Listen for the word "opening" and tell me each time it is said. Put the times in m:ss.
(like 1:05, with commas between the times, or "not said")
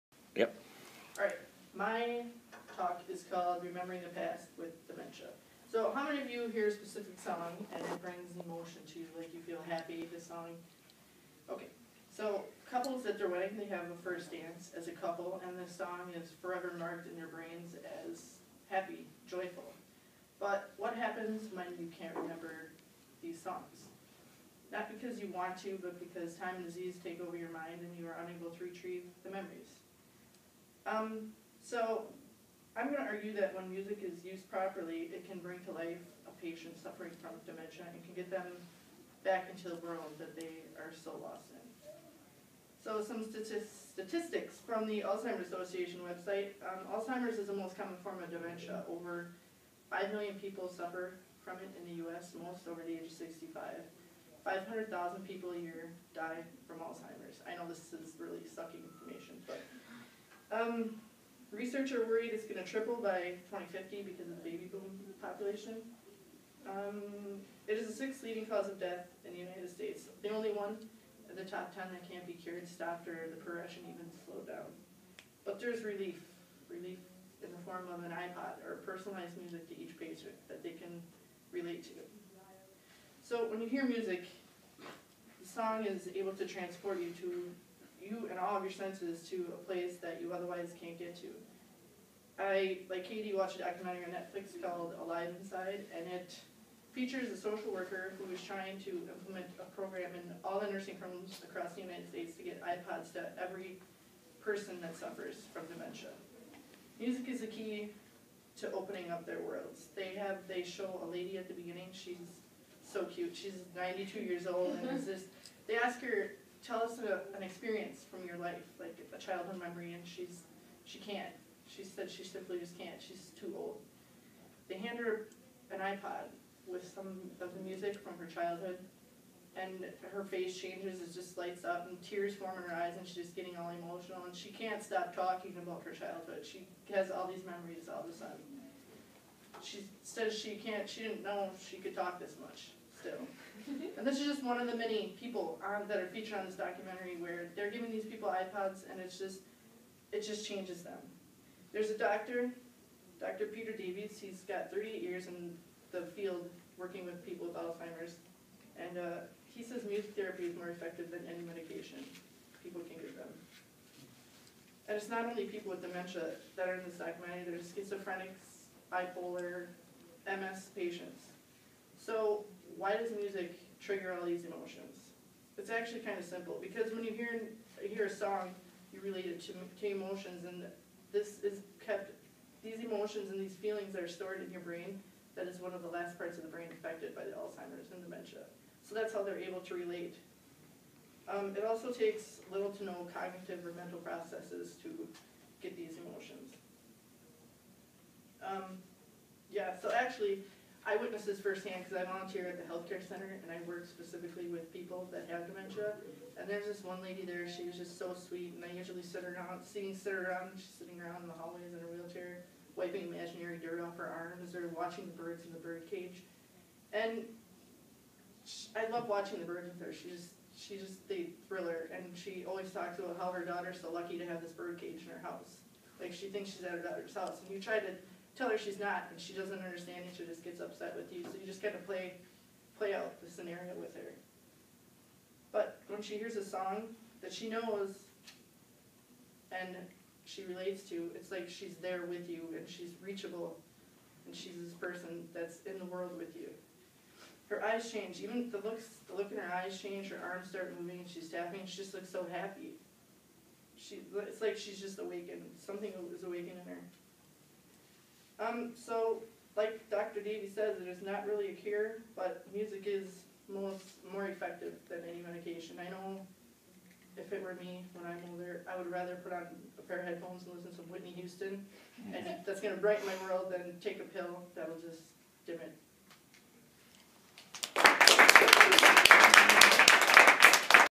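1:48.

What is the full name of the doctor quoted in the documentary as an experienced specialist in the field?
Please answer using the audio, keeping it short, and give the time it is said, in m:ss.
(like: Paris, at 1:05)
Peter Davies, at 2:33.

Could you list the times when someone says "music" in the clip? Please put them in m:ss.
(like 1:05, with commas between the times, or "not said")
0:33, 1:19, 1:23, 1:46, 2:07, 2:39, 2:53, 4:22.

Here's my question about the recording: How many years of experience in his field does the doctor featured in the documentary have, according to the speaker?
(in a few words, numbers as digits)
38.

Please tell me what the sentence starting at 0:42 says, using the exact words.
So some statistics from the Alzheimer's Association website.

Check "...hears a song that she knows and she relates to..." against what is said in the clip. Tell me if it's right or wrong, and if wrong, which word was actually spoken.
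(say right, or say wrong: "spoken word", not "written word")
right.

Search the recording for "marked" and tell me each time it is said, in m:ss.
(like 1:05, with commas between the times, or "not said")
0:16.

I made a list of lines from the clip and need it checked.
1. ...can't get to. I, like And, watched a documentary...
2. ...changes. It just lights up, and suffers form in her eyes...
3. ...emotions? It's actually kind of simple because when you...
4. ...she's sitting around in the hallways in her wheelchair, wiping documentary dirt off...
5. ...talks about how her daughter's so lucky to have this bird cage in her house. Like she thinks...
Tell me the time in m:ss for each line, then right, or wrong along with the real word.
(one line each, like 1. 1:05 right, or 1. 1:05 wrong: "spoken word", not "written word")
1. 1:30 wrong: "Katie", not "And"
2. 2:10 wrong: "tears", not "suffers"
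3. 2:54 right
4. 3:30 wrong: "imaginary", not "documentary"
5. 3:42 right.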